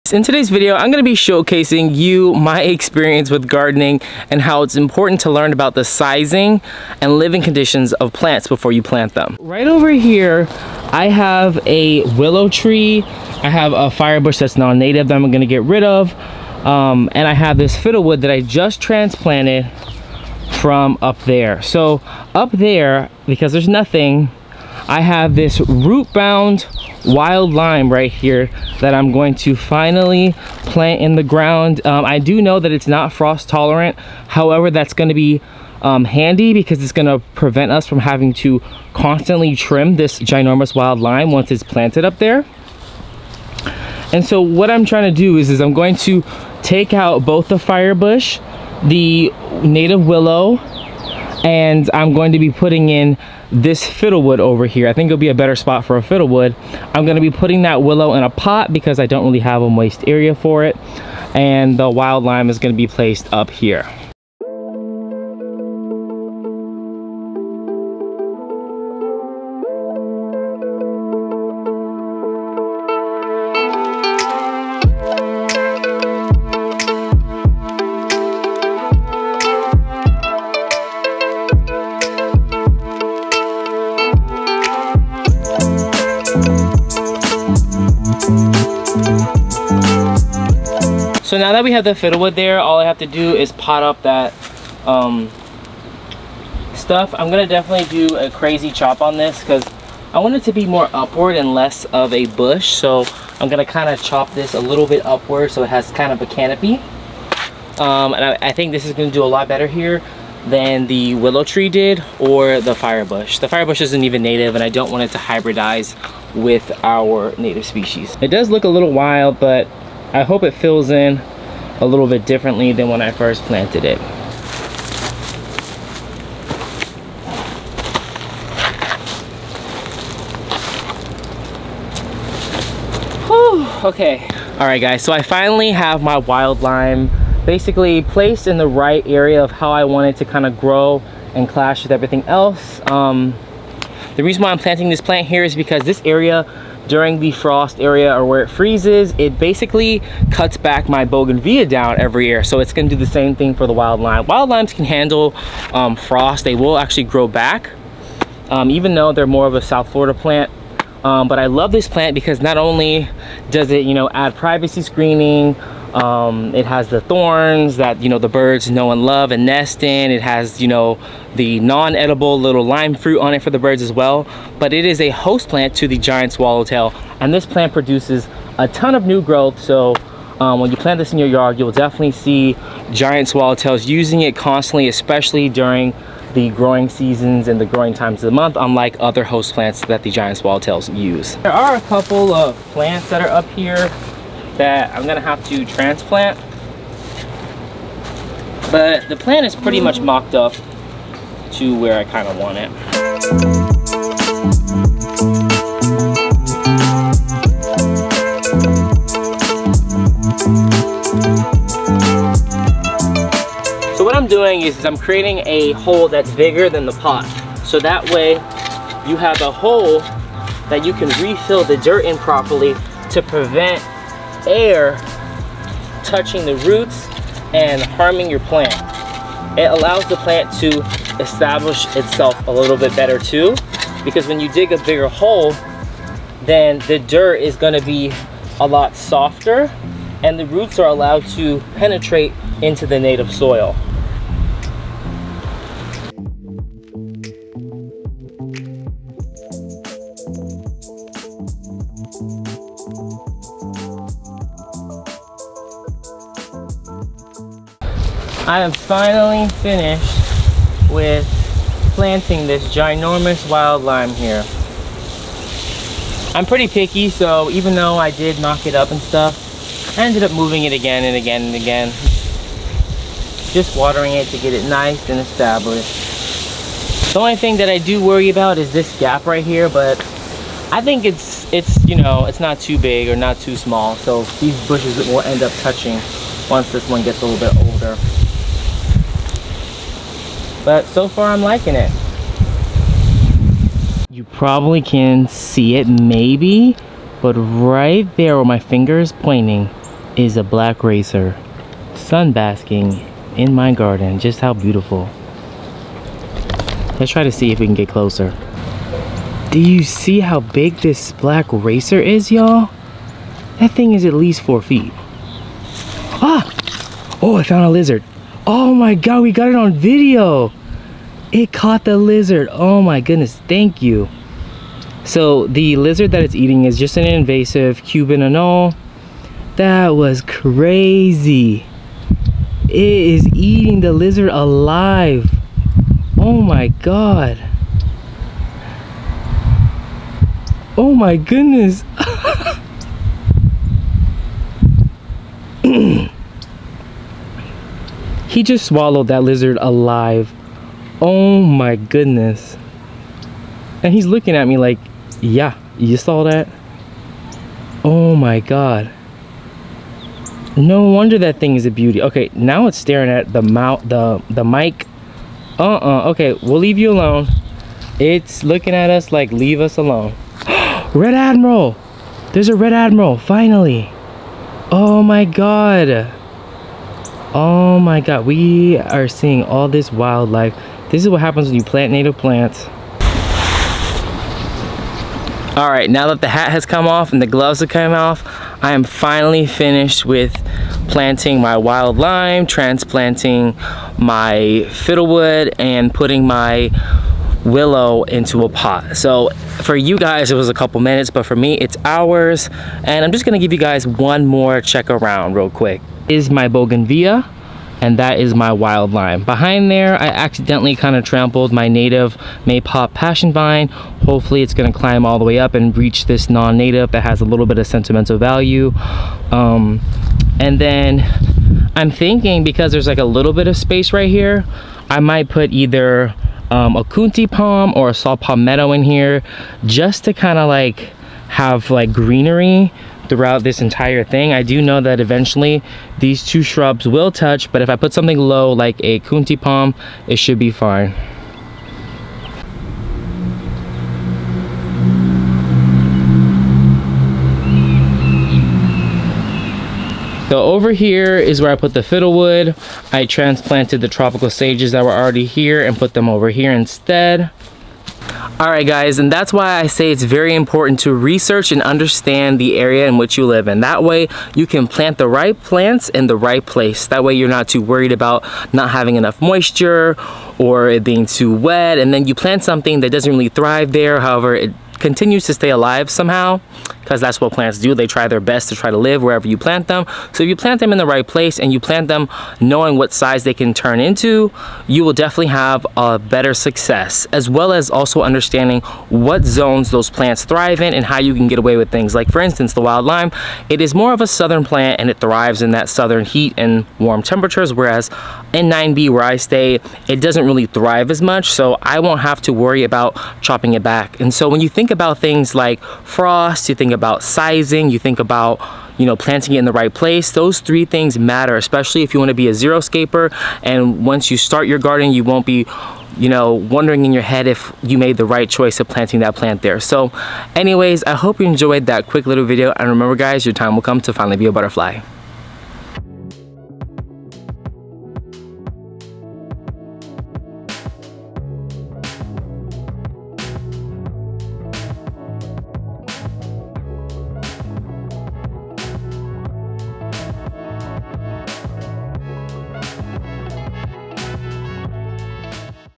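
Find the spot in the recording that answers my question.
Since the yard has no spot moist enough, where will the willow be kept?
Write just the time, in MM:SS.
00:57.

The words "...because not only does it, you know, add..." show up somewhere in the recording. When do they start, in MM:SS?
02:42.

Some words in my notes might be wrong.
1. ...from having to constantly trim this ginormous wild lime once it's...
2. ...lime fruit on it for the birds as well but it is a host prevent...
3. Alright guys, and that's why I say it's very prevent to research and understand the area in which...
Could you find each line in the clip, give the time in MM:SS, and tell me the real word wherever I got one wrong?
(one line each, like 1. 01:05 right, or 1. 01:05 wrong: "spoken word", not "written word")
1. 00:37 right
2. 02:52 wrong: "plant", not "prevent"
3. 07:38 wrong: "important", not "prevent".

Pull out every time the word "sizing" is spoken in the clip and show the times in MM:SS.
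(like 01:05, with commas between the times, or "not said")
00:05, 08:27.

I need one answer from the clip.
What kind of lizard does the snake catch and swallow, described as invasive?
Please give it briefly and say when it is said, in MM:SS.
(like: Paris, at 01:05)
Cuban anole, at 05:27.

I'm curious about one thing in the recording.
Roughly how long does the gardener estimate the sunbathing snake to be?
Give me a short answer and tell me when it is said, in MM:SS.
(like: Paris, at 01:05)
4 feet, at 05:14.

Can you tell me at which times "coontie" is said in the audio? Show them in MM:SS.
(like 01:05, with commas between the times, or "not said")
07:06, 07:19.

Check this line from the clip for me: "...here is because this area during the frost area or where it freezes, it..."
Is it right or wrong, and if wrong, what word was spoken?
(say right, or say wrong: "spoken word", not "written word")
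right.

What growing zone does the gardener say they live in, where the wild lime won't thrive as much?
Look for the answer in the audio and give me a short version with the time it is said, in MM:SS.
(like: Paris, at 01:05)
9B, at 08:18.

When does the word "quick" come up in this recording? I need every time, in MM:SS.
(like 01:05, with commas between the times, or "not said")
06:45, 08:41.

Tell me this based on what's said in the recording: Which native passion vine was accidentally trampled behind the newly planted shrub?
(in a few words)
Maypop.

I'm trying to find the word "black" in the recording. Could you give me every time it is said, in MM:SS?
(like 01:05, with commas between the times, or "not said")
05:00, 05:11.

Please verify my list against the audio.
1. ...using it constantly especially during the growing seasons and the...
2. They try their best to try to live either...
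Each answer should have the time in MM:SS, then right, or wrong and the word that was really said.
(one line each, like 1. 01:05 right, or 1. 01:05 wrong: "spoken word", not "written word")
1. 03:03 right
2. 07:57 wrong: "wherever", not "either".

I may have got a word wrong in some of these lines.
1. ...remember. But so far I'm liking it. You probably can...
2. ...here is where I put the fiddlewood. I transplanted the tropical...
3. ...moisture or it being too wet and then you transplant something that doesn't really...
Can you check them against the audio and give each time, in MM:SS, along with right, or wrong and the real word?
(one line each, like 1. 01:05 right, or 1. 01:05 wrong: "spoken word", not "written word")
1. 04:47 wrong: "older", not "remember"
2. 07:30 right
3. 07:49 wrong: "plant", not "transplant".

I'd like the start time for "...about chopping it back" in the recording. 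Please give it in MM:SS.
08:22.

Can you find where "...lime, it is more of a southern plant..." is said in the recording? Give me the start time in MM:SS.
08:12.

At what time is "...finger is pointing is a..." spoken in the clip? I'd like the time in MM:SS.
04:58.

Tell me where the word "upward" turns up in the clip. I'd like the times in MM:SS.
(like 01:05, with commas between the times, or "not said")
01:40, 01:45.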